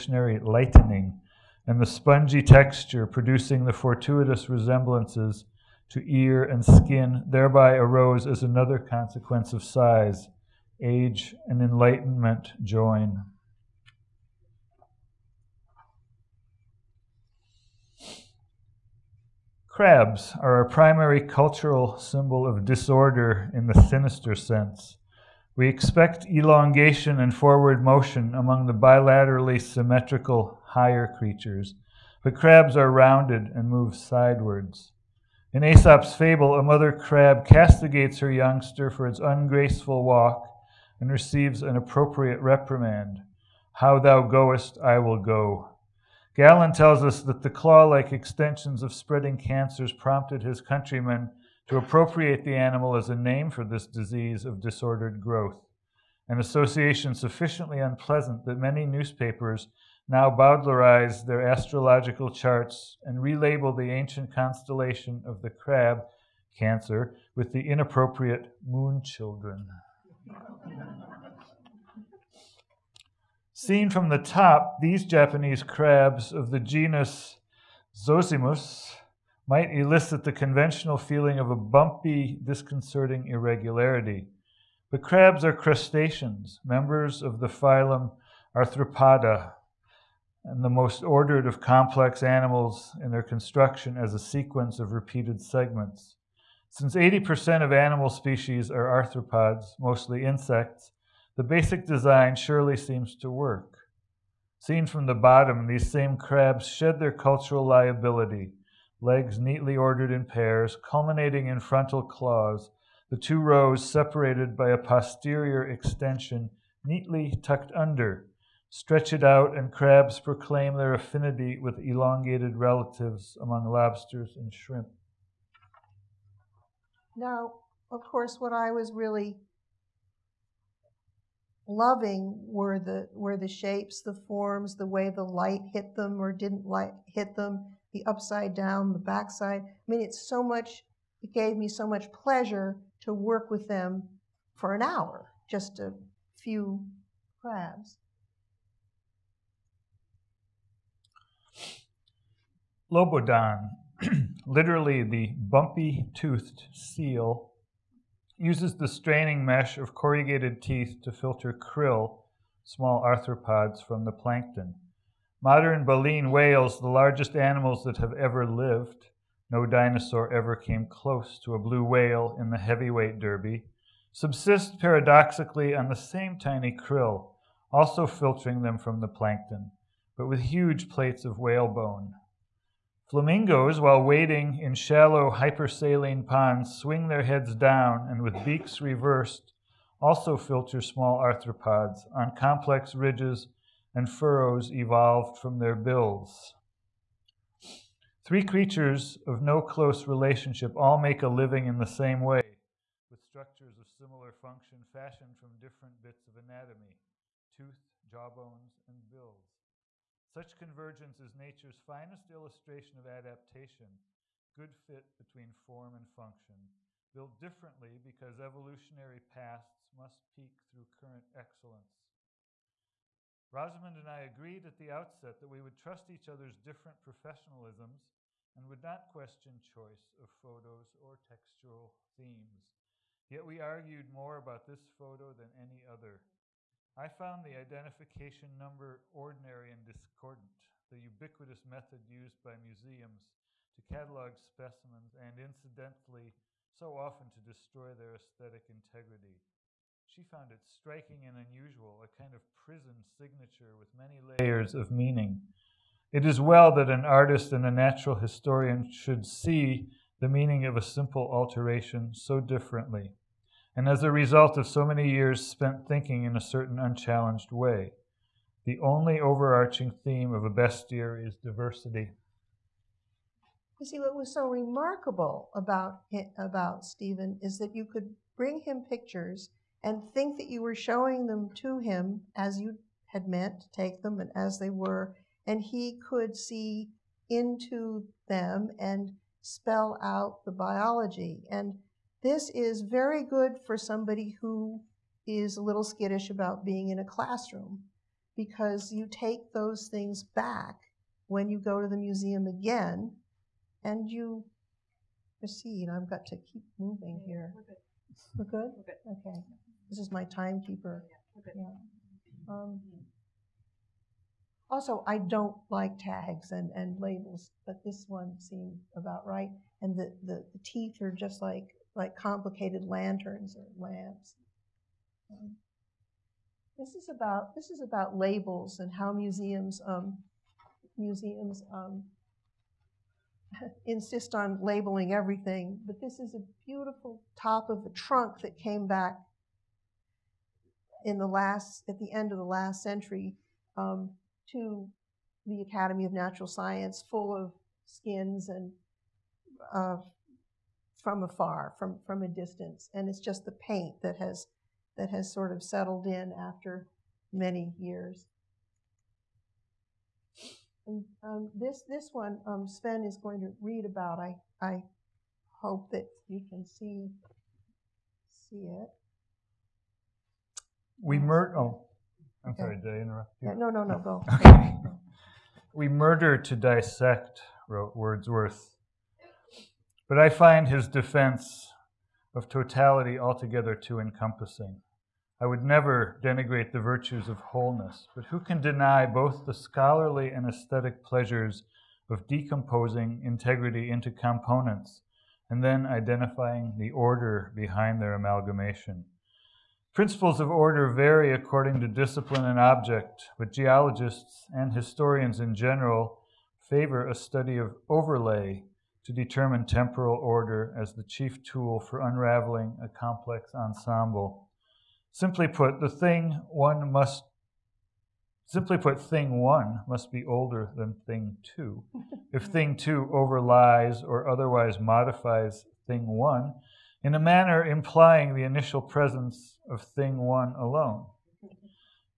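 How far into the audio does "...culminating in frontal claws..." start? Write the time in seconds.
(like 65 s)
110 s.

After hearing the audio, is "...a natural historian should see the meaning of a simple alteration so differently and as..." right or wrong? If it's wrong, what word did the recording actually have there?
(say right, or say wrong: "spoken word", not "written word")
right.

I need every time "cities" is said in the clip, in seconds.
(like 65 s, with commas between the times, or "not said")
not said.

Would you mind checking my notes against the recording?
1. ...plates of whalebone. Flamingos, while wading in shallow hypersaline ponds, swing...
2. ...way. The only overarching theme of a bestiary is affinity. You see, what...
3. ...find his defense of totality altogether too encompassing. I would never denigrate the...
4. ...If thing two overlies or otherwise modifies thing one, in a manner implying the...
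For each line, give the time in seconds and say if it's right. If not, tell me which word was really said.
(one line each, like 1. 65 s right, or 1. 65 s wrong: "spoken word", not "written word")
1. 180 s right
2. 267 s wrong: "diversity", not "affinity"
3. 380 s right
4. 422 s right.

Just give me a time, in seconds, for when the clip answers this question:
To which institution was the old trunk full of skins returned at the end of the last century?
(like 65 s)
345 s.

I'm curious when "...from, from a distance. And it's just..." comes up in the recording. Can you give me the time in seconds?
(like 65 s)
351 s.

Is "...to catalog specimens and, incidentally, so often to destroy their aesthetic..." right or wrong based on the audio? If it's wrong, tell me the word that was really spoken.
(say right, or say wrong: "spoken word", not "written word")
right.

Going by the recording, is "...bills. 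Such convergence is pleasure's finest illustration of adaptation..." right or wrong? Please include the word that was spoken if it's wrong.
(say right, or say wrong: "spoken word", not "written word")
wrong: "nature", not "pleasure".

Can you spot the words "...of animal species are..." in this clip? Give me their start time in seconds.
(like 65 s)
97 s.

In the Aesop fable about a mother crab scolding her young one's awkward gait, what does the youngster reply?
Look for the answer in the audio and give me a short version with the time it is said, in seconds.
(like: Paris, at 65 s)
How thou goest, I will go, at 43 s.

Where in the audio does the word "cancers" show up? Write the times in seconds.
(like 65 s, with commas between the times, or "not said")
49 s, 66 s.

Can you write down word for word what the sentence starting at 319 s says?
And the, the, the teeth are just like like complicated lanterns or lamps.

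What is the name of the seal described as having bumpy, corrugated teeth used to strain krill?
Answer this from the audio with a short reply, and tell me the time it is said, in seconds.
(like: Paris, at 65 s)
Lobodon, at 152 s.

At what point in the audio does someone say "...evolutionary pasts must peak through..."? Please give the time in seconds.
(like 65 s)
218 s.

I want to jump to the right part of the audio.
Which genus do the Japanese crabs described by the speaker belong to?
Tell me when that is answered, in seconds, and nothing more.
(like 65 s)
77 s.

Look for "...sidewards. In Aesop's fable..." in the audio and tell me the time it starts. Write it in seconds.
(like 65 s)
33 s.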